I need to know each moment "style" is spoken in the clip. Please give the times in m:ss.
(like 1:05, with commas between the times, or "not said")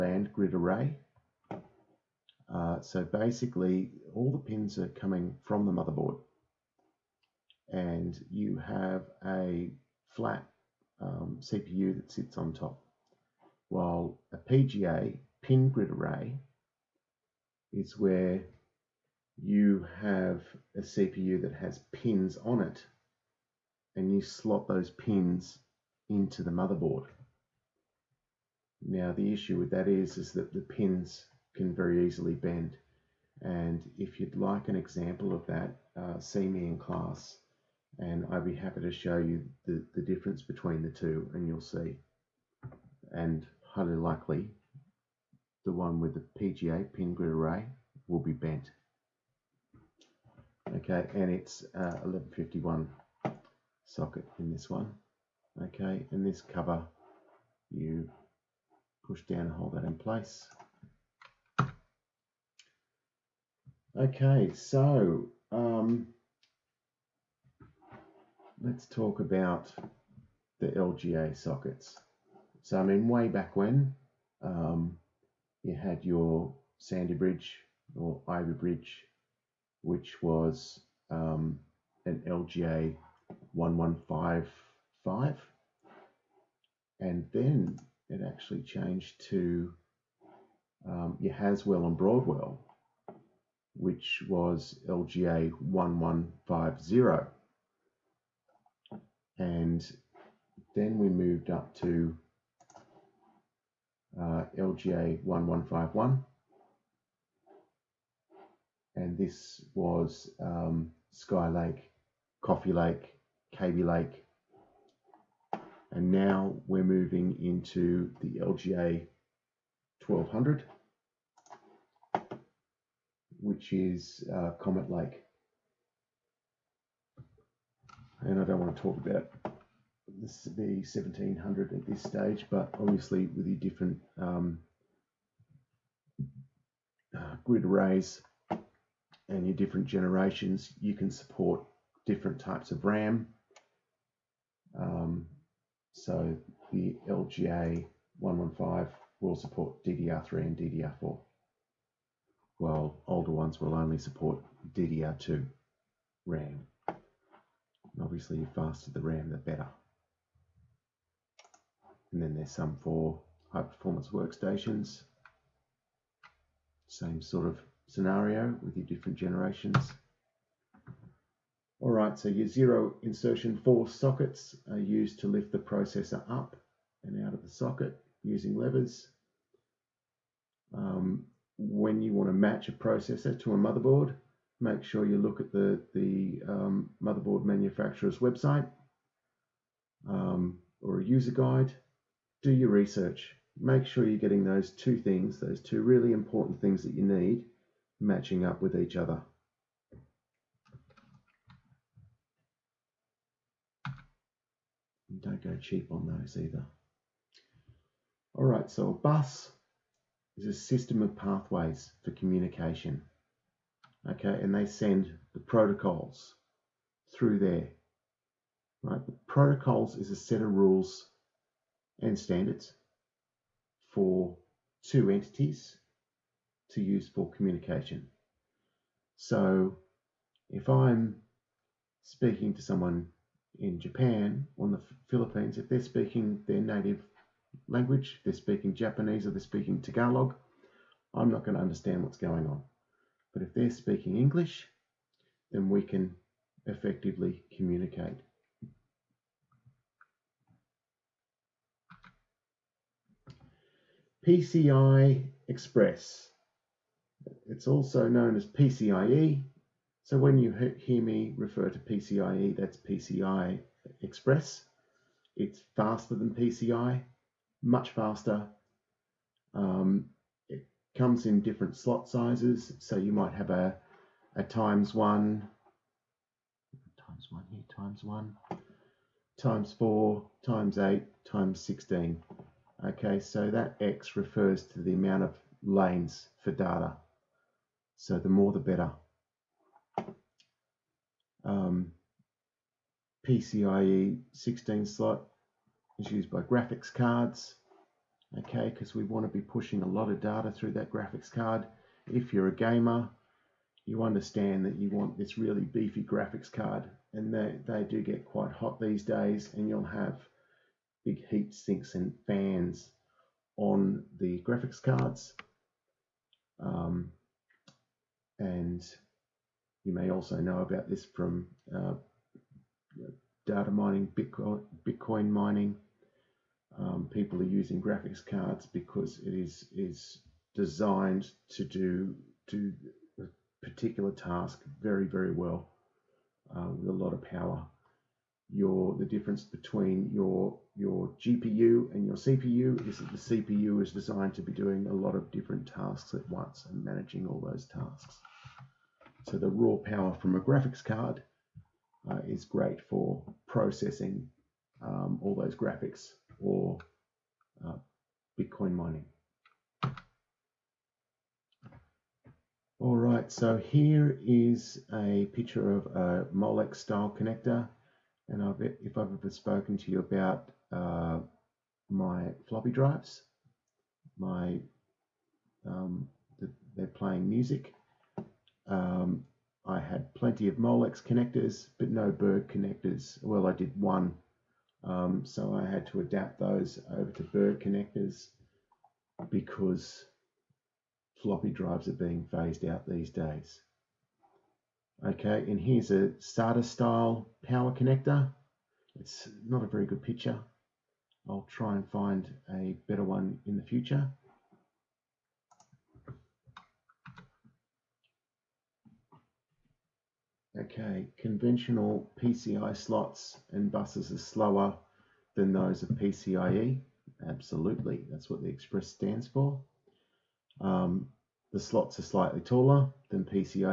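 6:06, 6:36.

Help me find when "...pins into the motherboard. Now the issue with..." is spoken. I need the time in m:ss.
0:24.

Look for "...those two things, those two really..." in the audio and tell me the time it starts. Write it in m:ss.
3:14.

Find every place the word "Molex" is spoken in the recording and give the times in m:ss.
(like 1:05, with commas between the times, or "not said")
6:06, 6:20.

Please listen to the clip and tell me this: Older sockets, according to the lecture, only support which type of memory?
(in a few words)
DDR2.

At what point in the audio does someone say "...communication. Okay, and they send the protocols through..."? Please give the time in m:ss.
3:32.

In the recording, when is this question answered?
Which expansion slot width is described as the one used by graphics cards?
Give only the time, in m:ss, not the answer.
4:53.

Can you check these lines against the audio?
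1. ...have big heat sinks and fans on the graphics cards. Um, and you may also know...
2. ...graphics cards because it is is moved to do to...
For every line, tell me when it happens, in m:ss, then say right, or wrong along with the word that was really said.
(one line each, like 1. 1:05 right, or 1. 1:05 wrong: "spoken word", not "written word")
1. 5:09 right
2. 5:27 wrong: "designed", not "moved".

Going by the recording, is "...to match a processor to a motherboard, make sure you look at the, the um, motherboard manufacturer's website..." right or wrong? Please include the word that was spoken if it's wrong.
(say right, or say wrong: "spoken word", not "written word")
right.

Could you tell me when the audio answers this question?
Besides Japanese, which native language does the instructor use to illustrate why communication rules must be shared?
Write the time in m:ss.
3:59.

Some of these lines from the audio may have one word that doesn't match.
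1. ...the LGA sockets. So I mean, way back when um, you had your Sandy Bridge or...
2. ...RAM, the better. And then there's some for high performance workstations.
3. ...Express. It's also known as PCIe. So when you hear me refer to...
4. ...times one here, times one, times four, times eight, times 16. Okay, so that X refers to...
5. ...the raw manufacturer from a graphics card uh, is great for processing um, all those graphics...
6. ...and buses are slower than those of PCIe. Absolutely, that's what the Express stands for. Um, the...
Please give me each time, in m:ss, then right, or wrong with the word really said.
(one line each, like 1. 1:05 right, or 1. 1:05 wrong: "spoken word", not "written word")
1. 1:10 right
2. 2:38 right
3. 4:15 right
4. 4:36 right
5. 5:49 wrong: "power", not "manufacturer"
6. 6:53 right.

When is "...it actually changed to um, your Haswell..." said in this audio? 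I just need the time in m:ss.
1:28.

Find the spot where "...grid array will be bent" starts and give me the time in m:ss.
0:47.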